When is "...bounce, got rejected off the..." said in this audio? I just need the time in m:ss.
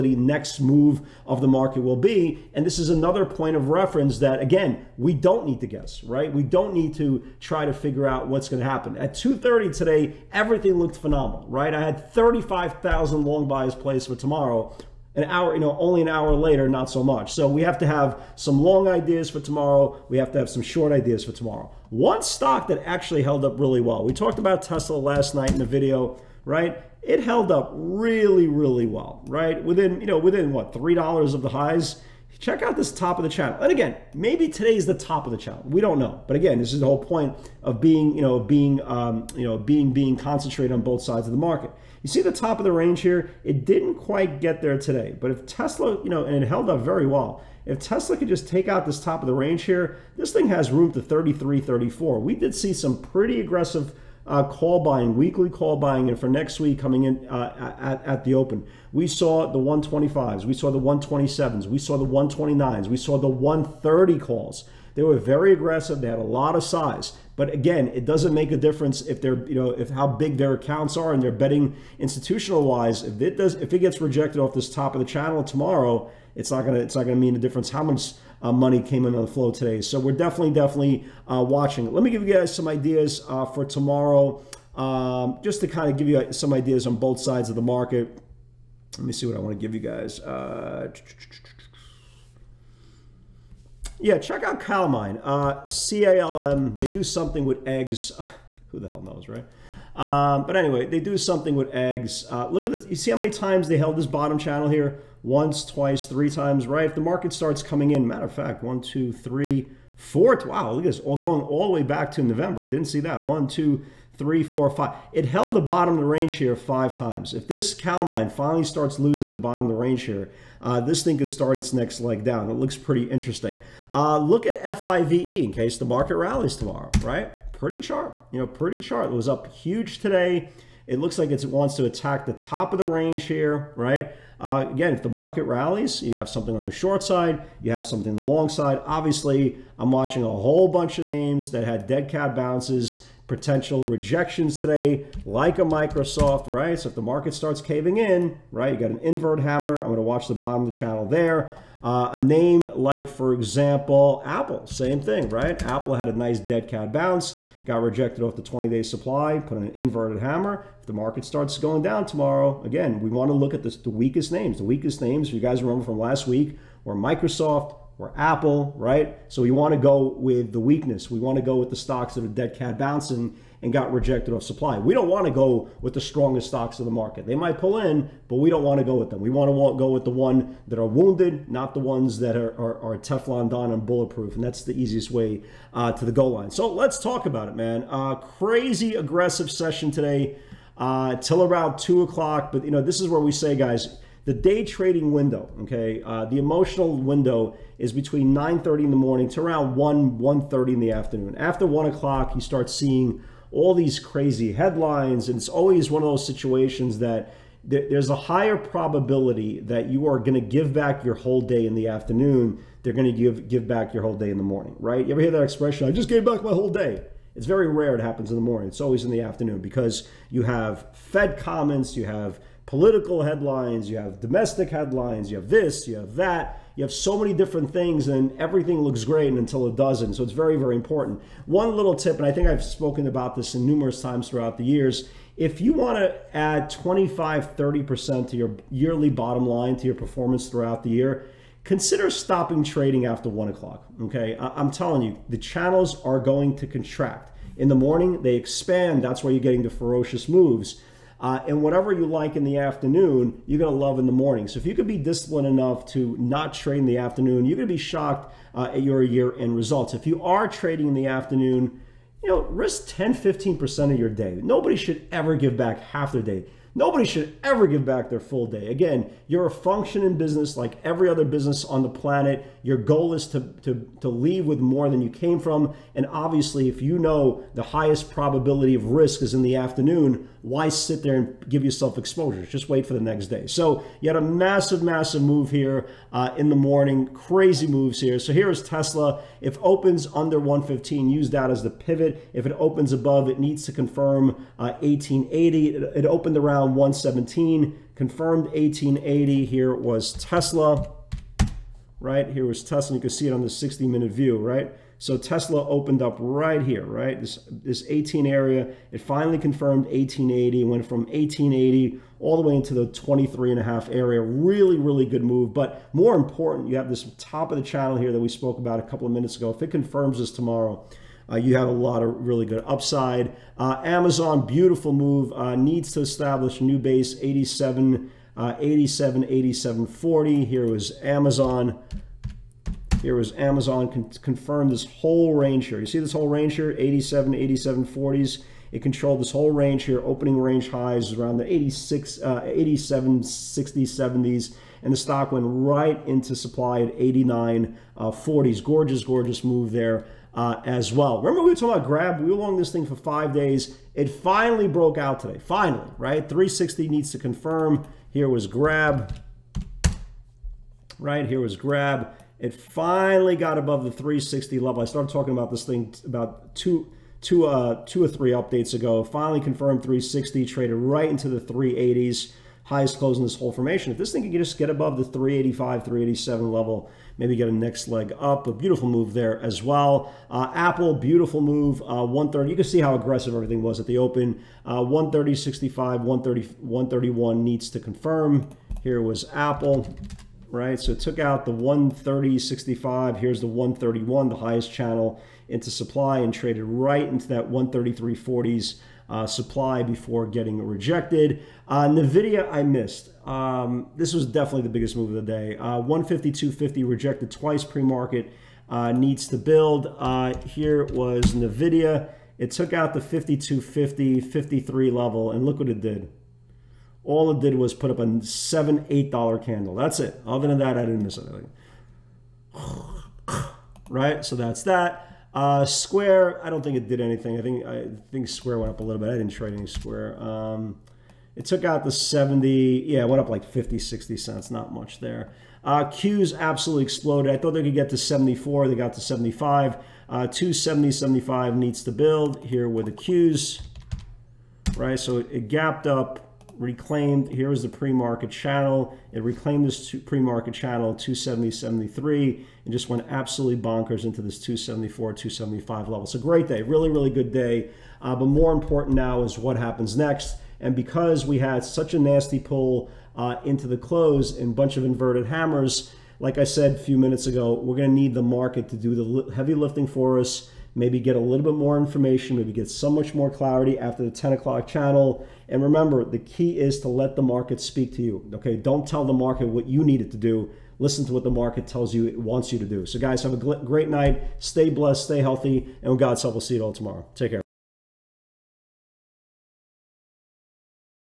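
2:36.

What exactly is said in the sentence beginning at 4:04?
Okay, I- am telling you, the channels are going to contract.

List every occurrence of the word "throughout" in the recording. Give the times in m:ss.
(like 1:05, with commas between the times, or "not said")
3:54, 4:00.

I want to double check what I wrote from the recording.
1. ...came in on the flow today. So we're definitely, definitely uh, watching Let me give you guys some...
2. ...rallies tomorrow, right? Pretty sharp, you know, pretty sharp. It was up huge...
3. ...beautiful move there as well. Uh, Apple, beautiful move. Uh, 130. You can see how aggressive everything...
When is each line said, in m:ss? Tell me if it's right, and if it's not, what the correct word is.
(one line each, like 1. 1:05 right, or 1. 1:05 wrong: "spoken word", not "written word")
1. 1:18 right
2. 2:06 right
3. 6:18 right.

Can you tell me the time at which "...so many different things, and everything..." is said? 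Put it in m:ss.
3:46.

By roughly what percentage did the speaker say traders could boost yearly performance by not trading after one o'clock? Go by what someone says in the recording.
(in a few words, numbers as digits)
25 to 30%.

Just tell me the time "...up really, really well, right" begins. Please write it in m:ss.
0:27.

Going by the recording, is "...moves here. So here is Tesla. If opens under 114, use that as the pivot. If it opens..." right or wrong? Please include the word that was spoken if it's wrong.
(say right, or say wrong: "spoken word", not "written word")
wrong: "115", not "114".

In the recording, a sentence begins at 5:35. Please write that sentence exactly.
You see this whole range here, 87, 87, 40s.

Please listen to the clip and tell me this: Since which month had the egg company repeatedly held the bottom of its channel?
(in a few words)
November.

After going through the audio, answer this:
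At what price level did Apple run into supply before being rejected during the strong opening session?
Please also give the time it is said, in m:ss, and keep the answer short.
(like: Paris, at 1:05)
133.40, at 6:37.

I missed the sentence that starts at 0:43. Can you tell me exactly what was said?
It didn't quite get there today.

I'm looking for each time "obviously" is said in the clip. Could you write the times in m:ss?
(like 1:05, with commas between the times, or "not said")
2:18, 4:36.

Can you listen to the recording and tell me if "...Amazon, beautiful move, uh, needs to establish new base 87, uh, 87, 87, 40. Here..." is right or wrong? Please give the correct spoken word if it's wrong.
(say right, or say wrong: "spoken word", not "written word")
right.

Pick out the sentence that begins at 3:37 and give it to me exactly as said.
It's very rare it happens in the morning.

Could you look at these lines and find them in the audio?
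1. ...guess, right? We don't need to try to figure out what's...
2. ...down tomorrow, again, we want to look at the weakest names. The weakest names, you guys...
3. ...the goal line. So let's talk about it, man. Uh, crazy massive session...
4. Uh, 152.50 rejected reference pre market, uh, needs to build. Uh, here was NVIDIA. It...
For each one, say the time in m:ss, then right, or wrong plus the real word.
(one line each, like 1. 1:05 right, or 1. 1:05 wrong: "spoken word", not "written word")
1. 0:05 right
2. 2:41 right
3. 3:06 wrong: "aggressive", not "massive"
4. 6:45 wrong: "twice", not "reference".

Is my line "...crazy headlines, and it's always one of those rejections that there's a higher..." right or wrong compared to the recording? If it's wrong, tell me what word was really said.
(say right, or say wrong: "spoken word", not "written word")
wrong: "situations", not "rejections".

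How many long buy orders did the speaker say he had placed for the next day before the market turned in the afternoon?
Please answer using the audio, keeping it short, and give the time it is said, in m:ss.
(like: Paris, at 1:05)
35,000, at 0:12.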